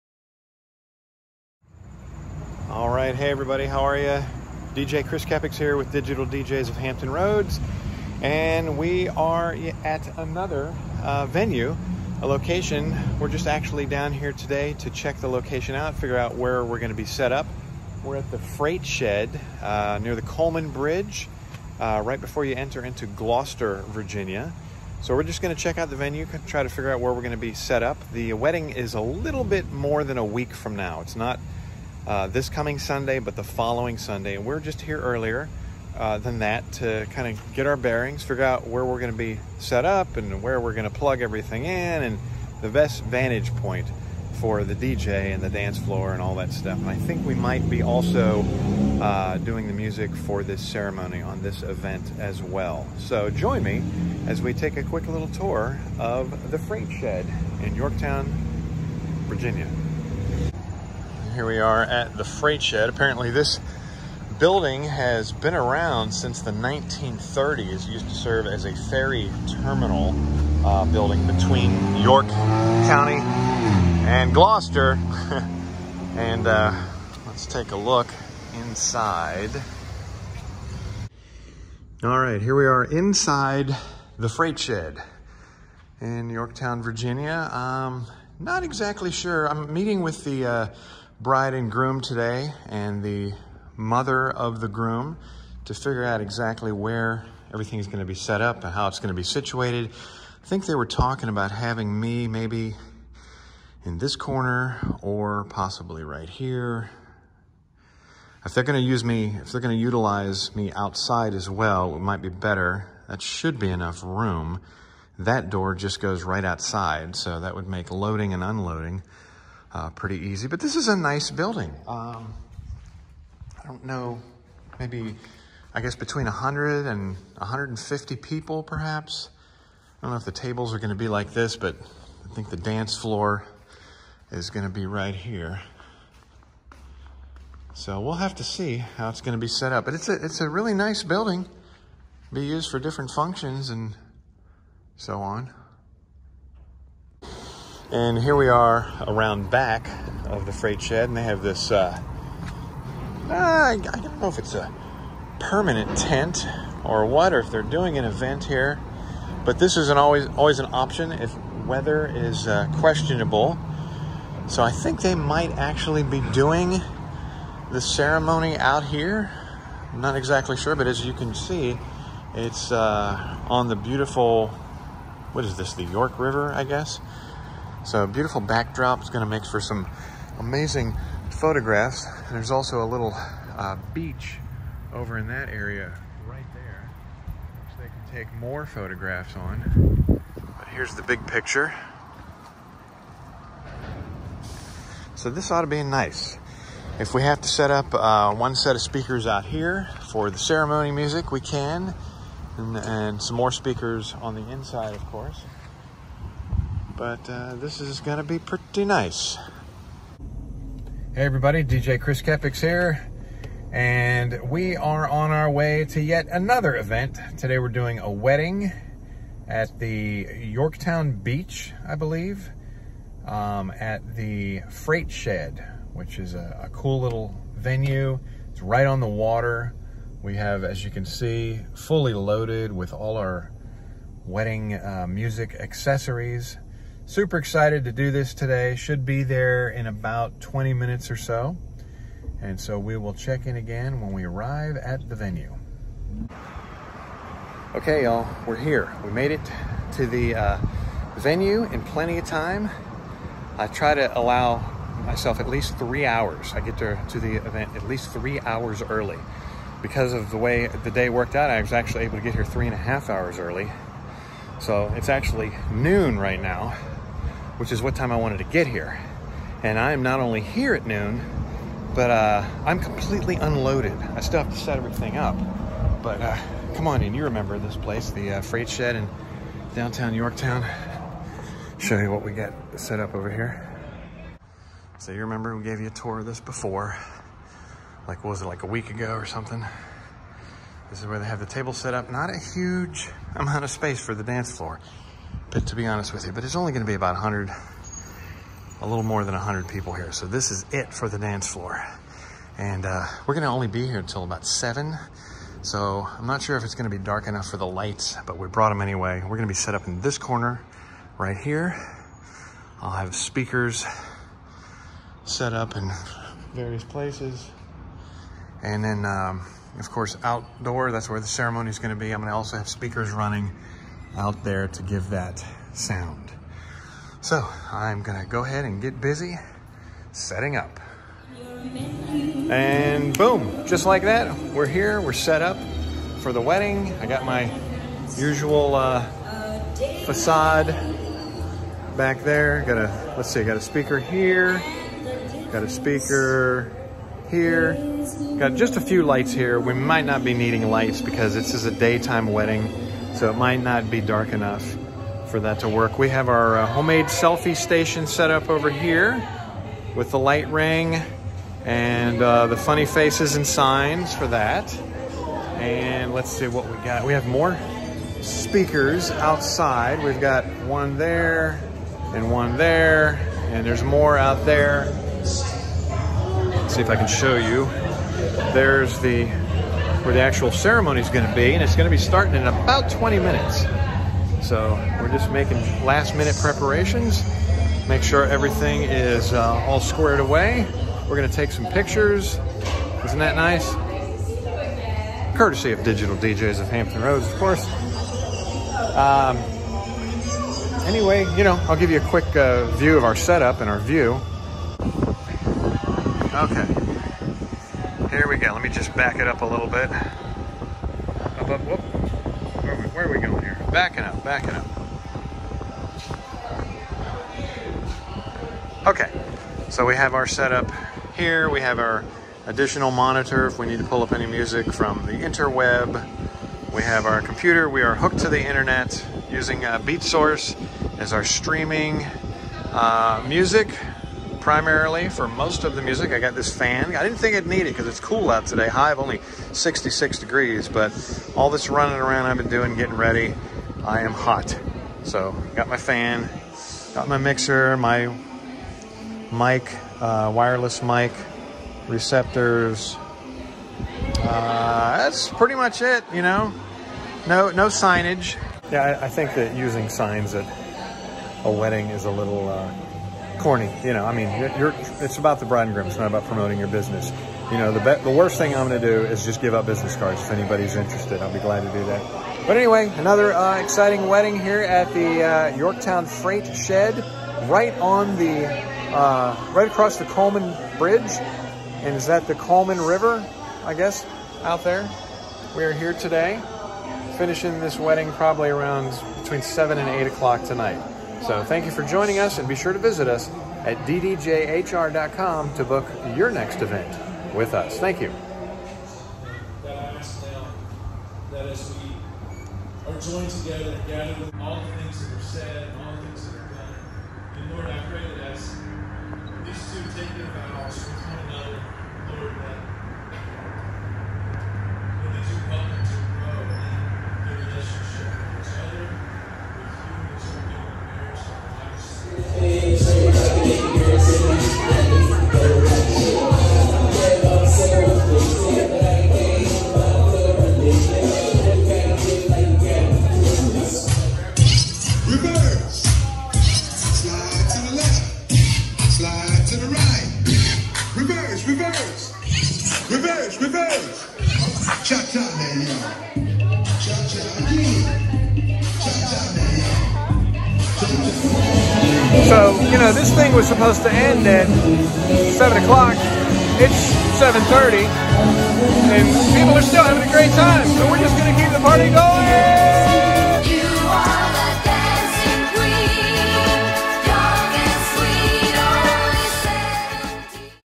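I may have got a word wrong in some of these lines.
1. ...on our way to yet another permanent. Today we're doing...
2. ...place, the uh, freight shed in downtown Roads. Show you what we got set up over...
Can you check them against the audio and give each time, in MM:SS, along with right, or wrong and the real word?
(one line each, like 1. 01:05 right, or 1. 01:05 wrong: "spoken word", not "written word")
1. 03:35 wrong: "event", not "permanent"
2. 04:37 wrong: "Yorktown", not "Roads".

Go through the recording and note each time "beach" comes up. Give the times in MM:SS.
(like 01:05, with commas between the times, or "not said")
03:03, 03:41.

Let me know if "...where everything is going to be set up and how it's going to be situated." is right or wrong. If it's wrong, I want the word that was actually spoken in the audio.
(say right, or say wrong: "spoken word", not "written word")
right.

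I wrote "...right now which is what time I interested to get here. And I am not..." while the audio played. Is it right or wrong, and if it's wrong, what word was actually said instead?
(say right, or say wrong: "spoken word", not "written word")
wrong: "wanted", not "interested".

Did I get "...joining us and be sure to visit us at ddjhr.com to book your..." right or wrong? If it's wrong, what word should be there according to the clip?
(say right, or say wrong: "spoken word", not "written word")
right.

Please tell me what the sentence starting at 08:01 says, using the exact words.
And is that the Coleman River, I guess, out there?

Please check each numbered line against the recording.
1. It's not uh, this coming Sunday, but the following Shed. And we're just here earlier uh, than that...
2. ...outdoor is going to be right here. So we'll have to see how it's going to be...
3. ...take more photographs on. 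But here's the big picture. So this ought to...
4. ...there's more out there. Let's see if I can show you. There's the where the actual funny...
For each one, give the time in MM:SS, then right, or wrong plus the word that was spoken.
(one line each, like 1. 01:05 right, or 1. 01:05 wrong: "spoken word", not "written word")
1. 00:31 wrong: "Sunday", not "Shed"
2. 02:12 wrong: "floor", not "outdoor"
3. 03:08 right
4. 06:13 wrong: "ceremony", not "funny".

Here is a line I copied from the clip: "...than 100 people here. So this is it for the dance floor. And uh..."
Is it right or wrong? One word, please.
right.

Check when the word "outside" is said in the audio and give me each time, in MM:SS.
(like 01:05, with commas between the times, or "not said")
01:50, 01:56, 06:09.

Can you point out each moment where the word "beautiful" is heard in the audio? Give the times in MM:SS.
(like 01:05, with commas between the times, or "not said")
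02:53, 02:58.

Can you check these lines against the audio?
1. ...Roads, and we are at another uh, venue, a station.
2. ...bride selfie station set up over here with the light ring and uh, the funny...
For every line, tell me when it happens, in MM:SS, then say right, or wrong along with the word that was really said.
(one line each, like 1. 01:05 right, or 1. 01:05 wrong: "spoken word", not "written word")
1. 00:07 wrong: "location", not "station"
2. 05:56 wrong: "homemade", not "bride".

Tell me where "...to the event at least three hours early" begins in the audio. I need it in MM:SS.
04:17.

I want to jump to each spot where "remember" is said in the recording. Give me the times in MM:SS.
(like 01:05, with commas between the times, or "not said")
04:37, 04:45.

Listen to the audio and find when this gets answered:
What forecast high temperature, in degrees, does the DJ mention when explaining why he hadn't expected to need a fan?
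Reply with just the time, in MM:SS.
07:19.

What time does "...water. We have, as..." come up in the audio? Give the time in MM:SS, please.
03:49.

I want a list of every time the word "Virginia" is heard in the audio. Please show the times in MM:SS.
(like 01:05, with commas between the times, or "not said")
00:23, 00:59, 01:26.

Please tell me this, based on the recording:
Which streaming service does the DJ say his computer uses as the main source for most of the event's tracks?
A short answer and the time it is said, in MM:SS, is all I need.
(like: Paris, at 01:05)
BeatSource, at 07:09.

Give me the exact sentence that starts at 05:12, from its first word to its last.
I'll have speakers set up in various places.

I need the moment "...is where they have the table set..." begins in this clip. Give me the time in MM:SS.
04:51.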